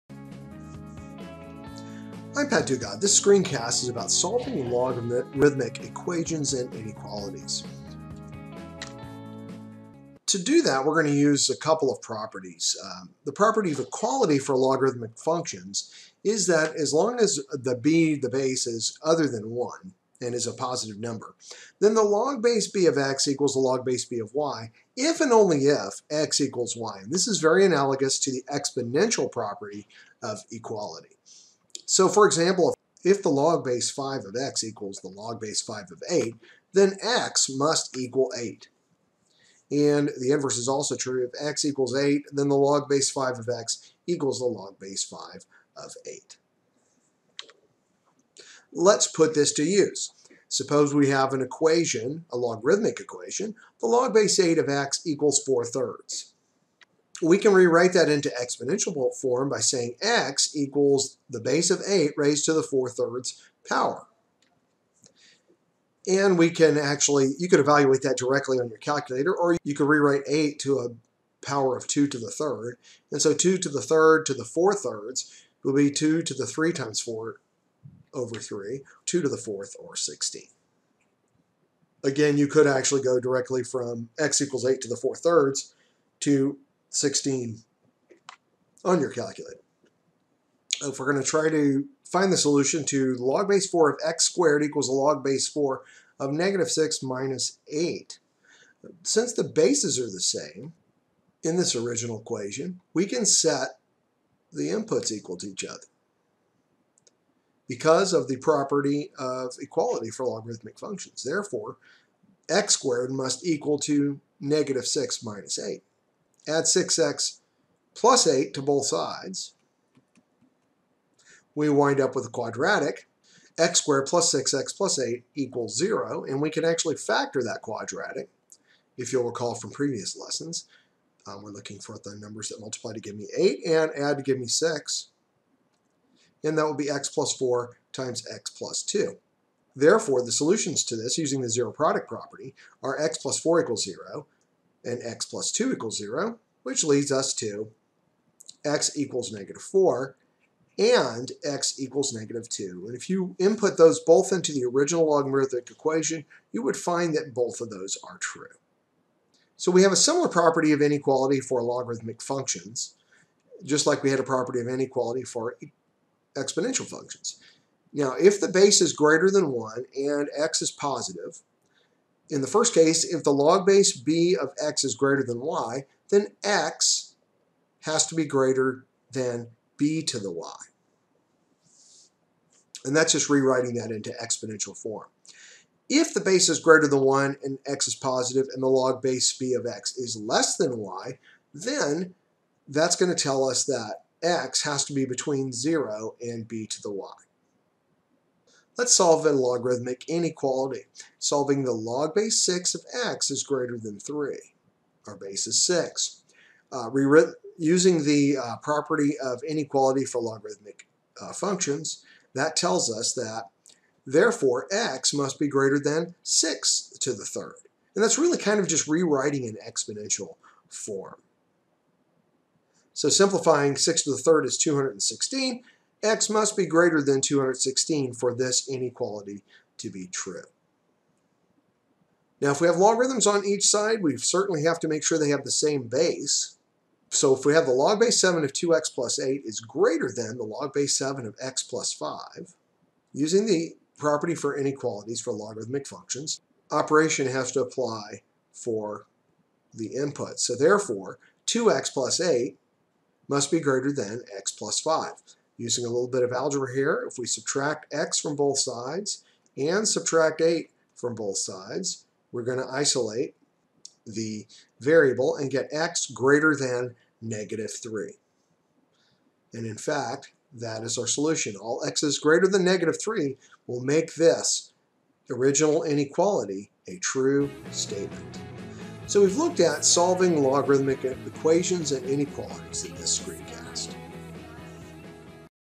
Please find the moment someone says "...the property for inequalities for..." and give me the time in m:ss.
4:03.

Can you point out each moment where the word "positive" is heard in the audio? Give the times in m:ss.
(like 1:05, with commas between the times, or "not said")
0:20, 2:50, 3:07.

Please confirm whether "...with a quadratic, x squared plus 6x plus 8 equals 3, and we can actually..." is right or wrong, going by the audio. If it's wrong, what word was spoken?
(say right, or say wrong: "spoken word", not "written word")
wrong: "0", not "3".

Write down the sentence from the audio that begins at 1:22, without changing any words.
Again, you could actually go directly from x equals 8 to the 4 thirds to 16 on your calculator.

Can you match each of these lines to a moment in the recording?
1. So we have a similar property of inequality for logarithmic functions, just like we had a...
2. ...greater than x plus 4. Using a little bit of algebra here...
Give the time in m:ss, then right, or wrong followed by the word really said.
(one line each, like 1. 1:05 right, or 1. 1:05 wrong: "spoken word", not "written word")
1. 2:39 right
2. 4:13 wrong: "5", not "4".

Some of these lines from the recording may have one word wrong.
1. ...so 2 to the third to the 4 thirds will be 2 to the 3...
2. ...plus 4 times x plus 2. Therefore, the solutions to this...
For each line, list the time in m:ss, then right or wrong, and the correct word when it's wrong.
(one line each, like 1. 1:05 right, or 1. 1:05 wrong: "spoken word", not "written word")
1. 1:13 right
2. 2:17 right.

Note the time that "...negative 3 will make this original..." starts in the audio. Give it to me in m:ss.
4:32.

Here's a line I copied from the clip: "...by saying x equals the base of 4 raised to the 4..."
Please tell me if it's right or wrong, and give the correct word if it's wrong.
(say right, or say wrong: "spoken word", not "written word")
wrong: "8", not "4".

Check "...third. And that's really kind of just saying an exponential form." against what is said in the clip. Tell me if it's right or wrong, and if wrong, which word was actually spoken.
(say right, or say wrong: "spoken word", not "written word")
wrong: "rewriting", not "saying".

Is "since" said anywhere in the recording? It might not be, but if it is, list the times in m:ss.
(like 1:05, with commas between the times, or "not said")
1:39.